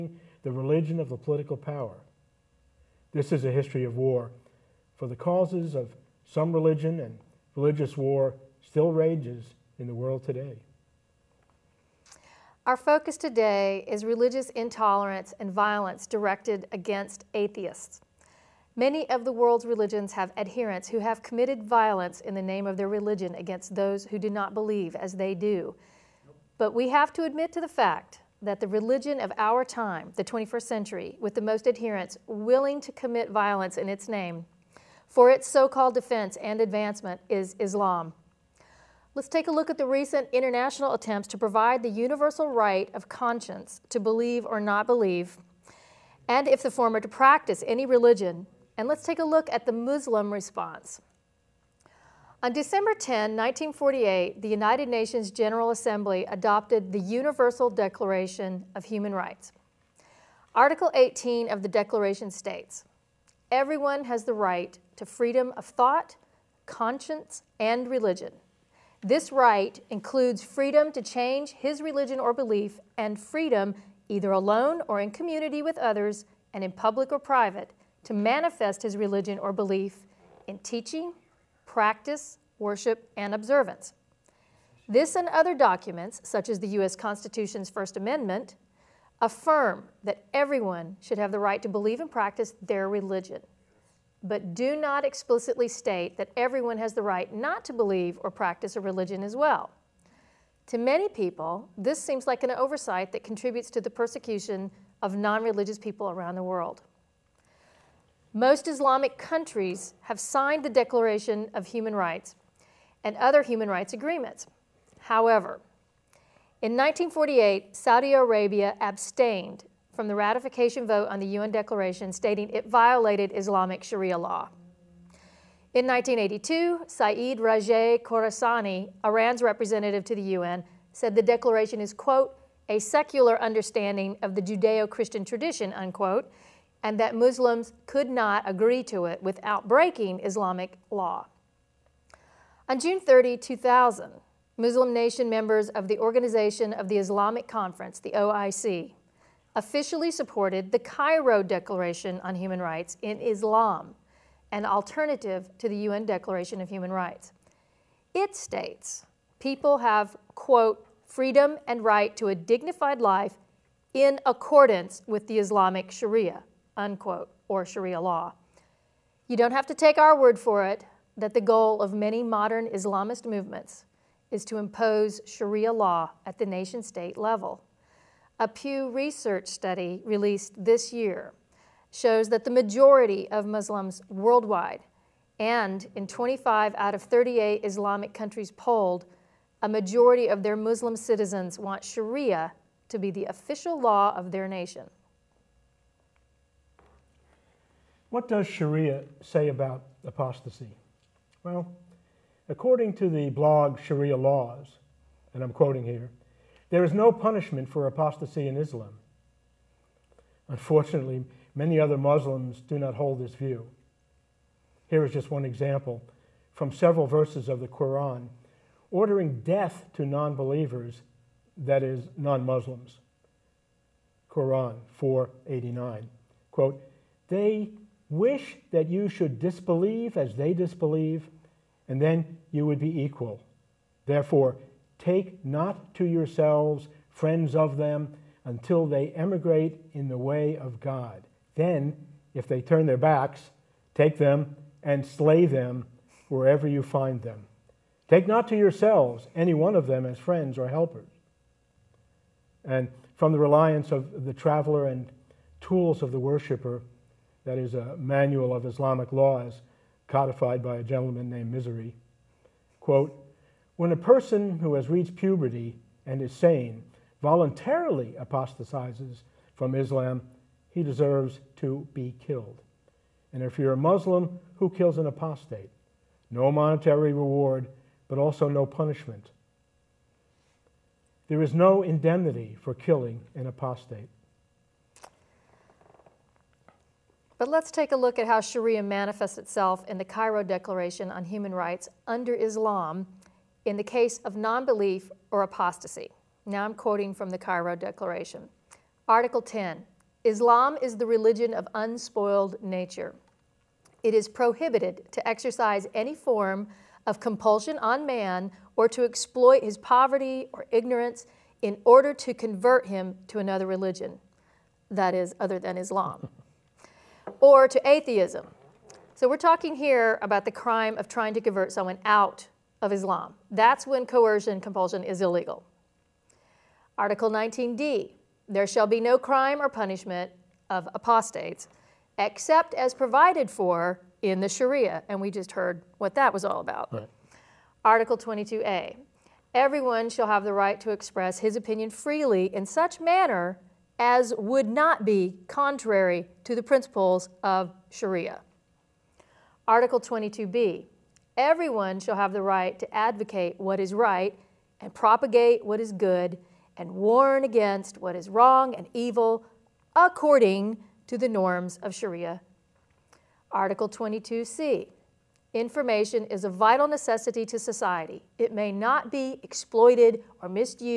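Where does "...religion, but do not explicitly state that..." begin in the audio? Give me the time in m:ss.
1:32.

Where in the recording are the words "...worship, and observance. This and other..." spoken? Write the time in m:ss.
1:22.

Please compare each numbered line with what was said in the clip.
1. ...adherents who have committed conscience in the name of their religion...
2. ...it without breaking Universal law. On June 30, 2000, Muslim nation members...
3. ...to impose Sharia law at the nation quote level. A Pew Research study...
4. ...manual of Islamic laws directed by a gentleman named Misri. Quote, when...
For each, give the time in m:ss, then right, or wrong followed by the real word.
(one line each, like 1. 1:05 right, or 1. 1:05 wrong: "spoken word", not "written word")
1. 0:20 wrong: "violence", not "conscience"
2. 2:19 wrong: "Islamic", not "Universal"
3. 2:54 wrong: "state", not "quote"
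4. 4:17 wrong: "codified", not "directed".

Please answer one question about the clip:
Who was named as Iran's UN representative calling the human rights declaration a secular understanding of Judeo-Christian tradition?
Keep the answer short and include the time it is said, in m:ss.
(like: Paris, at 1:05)
Saeed Rajay Khorasani, at 2:06.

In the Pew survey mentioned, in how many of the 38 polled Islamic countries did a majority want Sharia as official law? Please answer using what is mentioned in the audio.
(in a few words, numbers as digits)
25.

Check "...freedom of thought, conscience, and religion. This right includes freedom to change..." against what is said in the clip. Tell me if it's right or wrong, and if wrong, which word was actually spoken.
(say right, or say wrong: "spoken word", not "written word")
right.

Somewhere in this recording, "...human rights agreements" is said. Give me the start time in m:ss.
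1:53.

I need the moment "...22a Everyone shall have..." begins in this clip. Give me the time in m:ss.
5:38.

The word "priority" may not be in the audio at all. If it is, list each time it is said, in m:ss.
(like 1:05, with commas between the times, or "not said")
not said.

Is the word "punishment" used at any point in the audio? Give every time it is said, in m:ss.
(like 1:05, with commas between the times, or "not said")
3:27, 4:38, 5:29.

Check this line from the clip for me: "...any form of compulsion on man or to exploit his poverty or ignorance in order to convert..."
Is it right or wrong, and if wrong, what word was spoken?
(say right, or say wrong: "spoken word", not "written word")
right.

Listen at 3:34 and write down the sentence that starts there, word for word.
Here is just one example from several verses of the Quran ordering death to non believers, that is, non Muslims.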